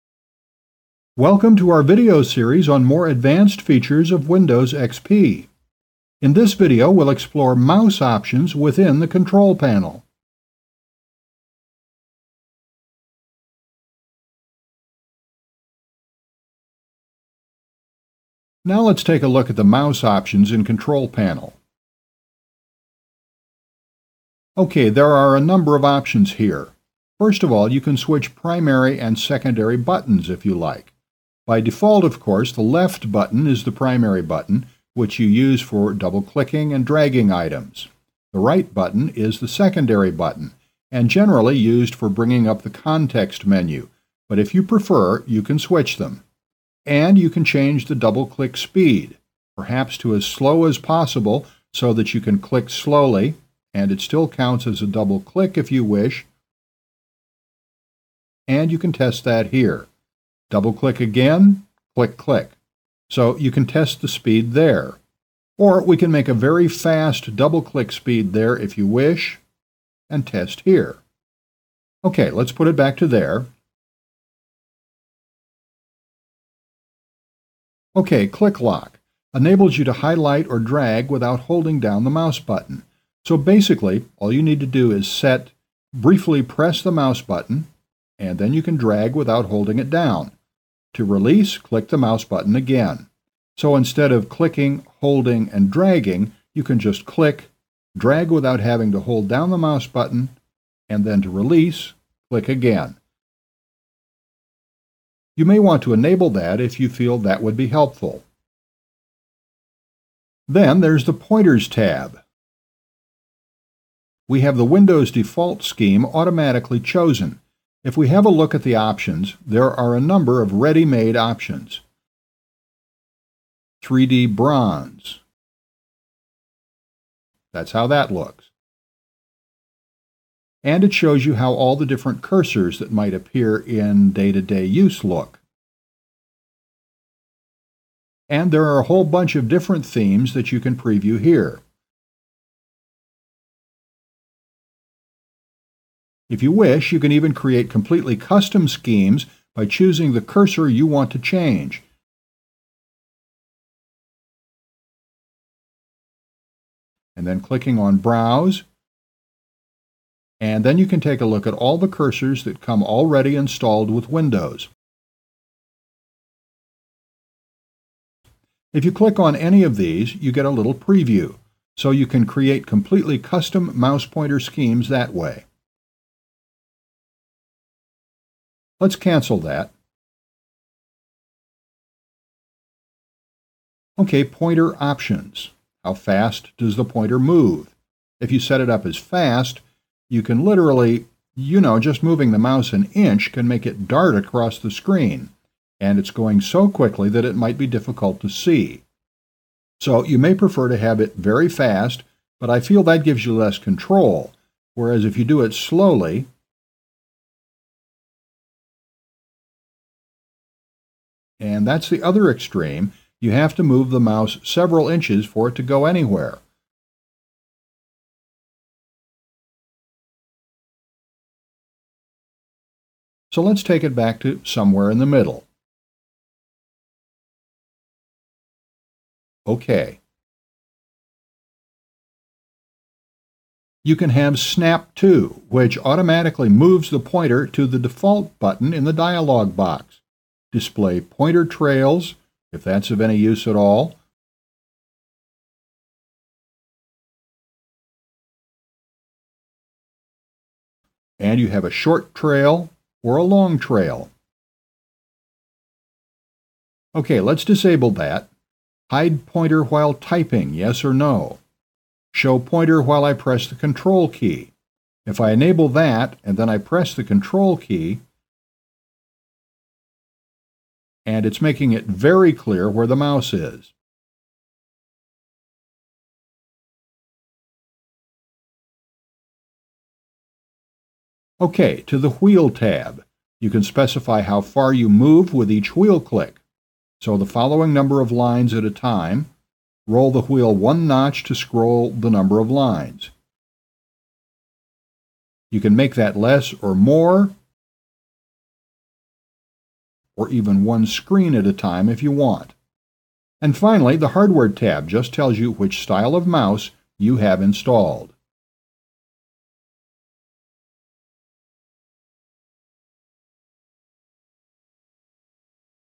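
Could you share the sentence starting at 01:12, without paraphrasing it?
Okay, let's put it back to there.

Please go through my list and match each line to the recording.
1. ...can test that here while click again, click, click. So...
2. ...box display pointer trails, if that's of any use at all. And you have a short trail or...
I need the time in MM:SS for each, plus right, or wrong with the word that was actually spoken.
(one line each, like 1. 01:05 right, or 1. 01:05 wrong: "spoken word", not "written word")
1. 00:58 wrong: "double", not "while"
2. 03:59 right.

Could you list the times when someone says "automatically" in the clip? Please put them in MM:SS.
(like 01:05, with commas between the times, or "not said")
01:56, 03:55.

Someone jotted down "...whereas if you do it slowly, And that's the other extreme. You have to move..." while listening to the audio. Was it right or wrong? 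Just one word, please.
right.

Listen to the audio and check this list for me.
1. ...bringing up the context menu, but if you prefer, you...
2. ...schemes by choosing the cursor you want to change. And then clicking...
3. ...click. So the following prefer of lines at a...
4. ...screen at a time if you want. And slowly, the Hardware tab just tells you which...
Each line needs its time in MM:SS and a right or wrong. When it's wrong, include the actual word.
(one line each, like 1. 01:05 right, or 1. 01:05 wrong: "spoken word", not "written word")
1. 00:42 right
2. 02:28 right
3. 04:45 wrong: "number", not "prefer"
4. 05:00 wrong: "finally", not "slowly".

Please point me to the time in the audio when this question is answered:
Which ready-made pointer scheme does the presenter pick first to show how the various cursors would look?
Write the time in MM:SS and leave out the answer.
02:03.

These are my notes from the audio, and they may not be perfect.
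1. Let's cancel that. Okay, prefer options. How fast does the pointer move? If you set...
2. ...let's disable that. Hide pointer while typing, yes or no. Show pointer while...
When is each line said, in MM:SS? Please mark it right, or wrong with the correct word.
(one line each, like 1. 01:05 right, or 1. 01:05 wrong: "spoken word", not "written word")
1. 02:58 wrong: "pointer", not "prefer"
2. 04:17 right.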